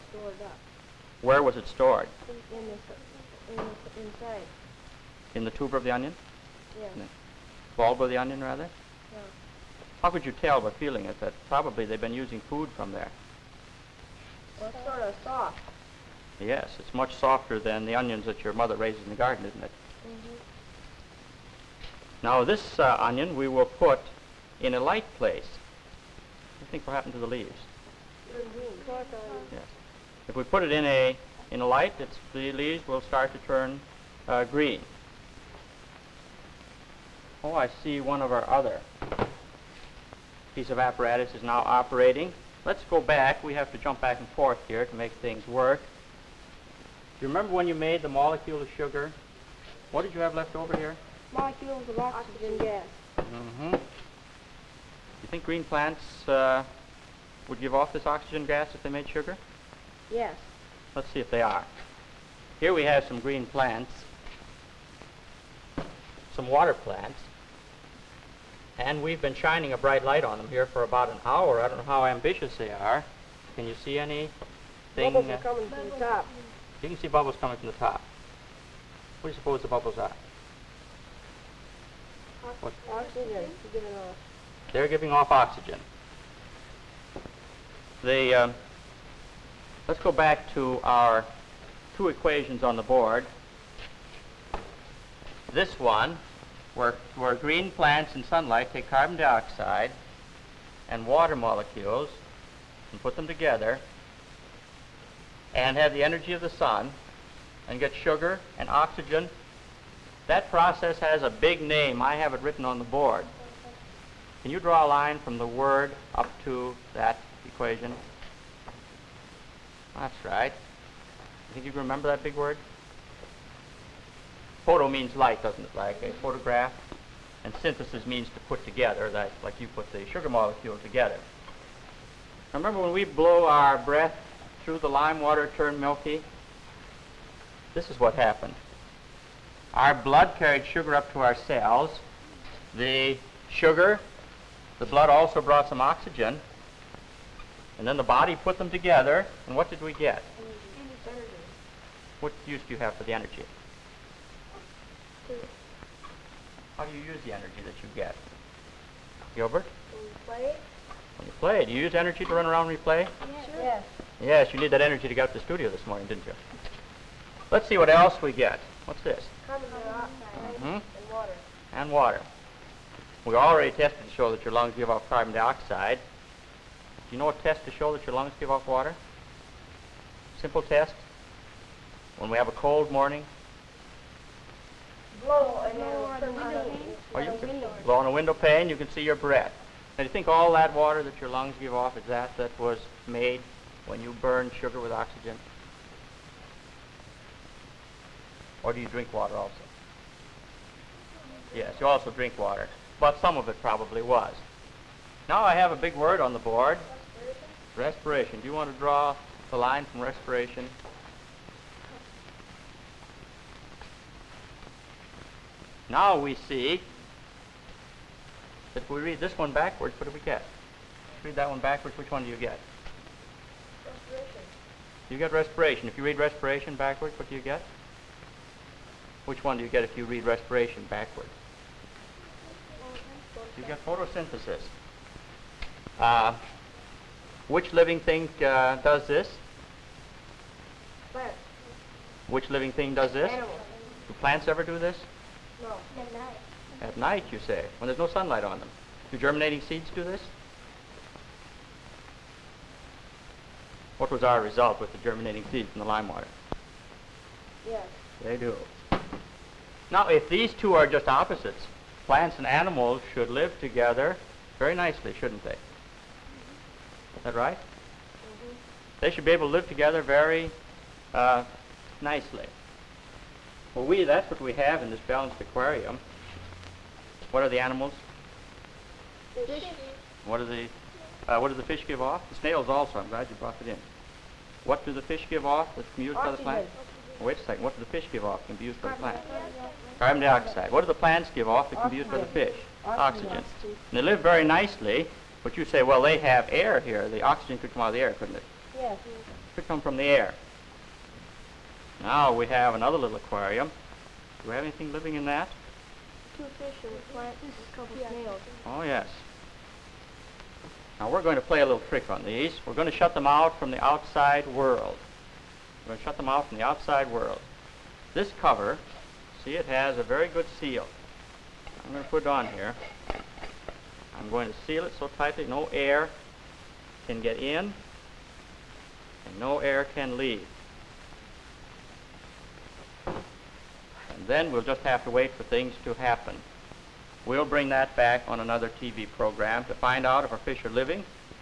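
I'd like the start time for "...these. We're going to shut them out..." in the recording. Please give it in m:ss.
5:12.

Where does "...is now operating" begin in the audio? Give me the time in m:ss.
0:41.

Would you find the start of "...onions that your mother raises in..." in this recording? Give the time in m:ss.
0:17.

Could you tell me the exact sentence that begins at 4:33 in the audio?
Well, we, that's what we have in this balanced aquarium.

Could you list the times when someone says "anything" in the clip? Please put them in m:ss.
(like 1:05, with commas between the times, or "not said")
5:04.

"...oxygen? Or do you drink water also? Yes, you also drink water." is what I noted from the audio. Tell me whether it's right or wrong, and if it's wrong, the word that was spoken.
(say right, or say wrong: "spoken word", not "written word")
right.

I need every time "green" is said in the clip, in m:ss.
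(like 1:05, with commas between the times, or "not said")
0:34, 0:55, 1:03, 1:37.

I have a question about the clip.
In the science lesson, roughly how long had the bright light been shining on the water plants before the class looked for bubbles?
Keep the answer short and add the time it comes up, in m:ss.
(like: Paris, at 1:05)
About an hour, at 1:10.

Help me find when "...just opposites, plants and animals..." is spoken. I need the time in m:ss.
4:20.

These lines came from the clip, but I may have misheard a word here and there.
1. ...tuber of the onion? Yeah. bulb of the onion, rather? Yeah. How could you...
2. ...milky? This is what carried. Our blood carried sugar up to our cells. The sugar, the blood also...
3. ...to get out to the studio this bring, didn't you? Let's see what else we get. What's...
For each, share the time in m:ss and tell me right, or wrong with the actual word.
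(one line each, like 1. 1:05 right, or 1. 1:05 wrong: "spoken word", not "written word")
1. 0:05 right
2. 2:15 wrong: "happened", not "carried"
3. 2:45 wrong: "morning", not "bring".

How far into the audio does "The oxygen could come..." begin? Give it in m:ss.
4:57.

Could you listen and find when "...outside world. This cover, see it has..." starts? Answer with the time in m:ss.
5:16.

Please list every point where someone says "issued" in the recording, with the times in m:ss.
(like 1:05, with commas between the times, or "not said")
not said.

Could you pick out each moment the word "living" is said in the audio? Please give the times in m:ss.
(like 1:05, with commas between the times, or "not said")
3:57, 4:02, 5:04, 5:40.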